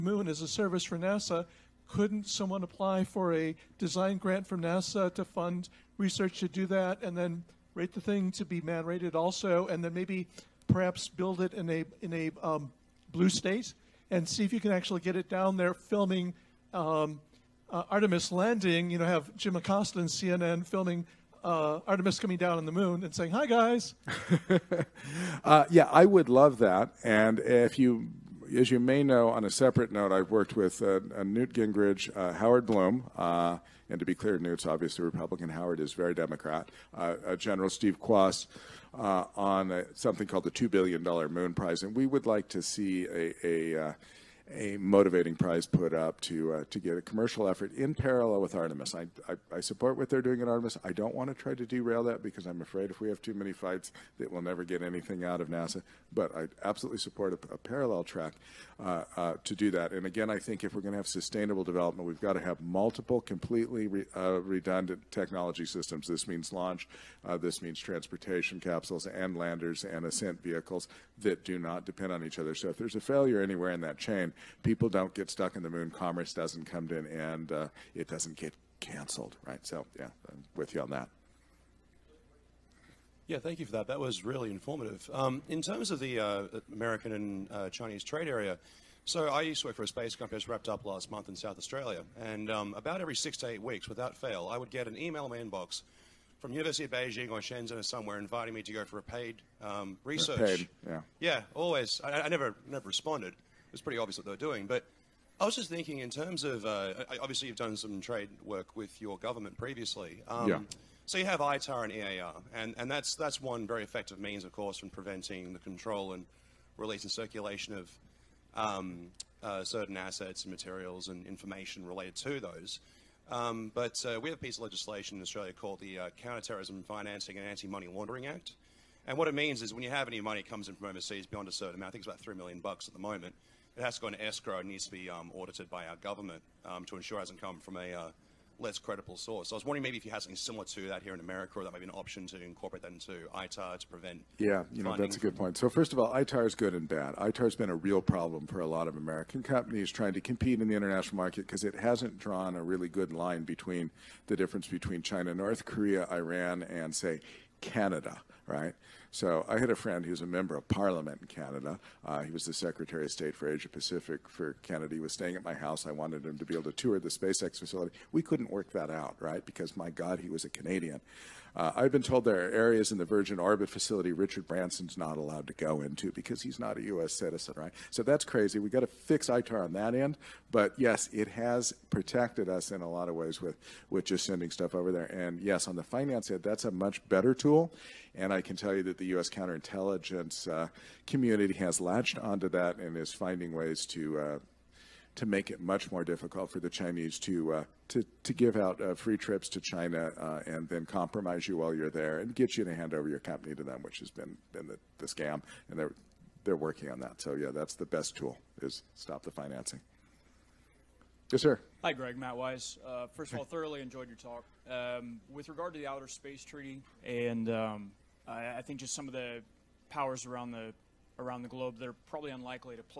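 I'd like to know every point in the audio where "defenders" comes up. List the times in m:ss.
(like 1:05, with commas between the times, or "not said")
not said.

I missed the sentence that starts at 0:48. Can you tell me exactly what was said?
I, I, I, support what they're doing at Artemis.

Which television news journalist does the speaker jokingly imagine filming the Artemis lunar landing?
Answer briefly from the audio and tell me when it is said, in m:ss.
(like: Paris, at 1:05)
Jim Acosta, at 0:19.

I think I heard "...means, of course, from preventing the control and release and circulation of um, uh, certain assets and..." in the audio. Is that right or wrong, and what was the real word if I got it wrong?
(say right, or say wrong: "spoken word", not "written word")
right.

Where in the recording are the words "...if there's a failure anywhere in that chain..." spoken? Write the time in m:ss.
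1:12.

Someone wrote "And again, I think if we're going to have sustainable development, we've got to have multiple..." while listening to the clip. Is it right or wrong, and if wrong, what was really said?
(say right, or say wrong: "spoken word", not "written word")
right.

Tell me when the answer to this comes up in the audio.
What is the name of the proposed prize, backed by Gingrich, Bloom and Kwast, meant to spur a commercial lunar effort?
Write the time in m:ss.
0:40.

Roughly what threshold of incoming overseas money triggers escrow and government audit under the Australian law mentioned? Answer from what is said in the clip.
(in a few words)
$3 million.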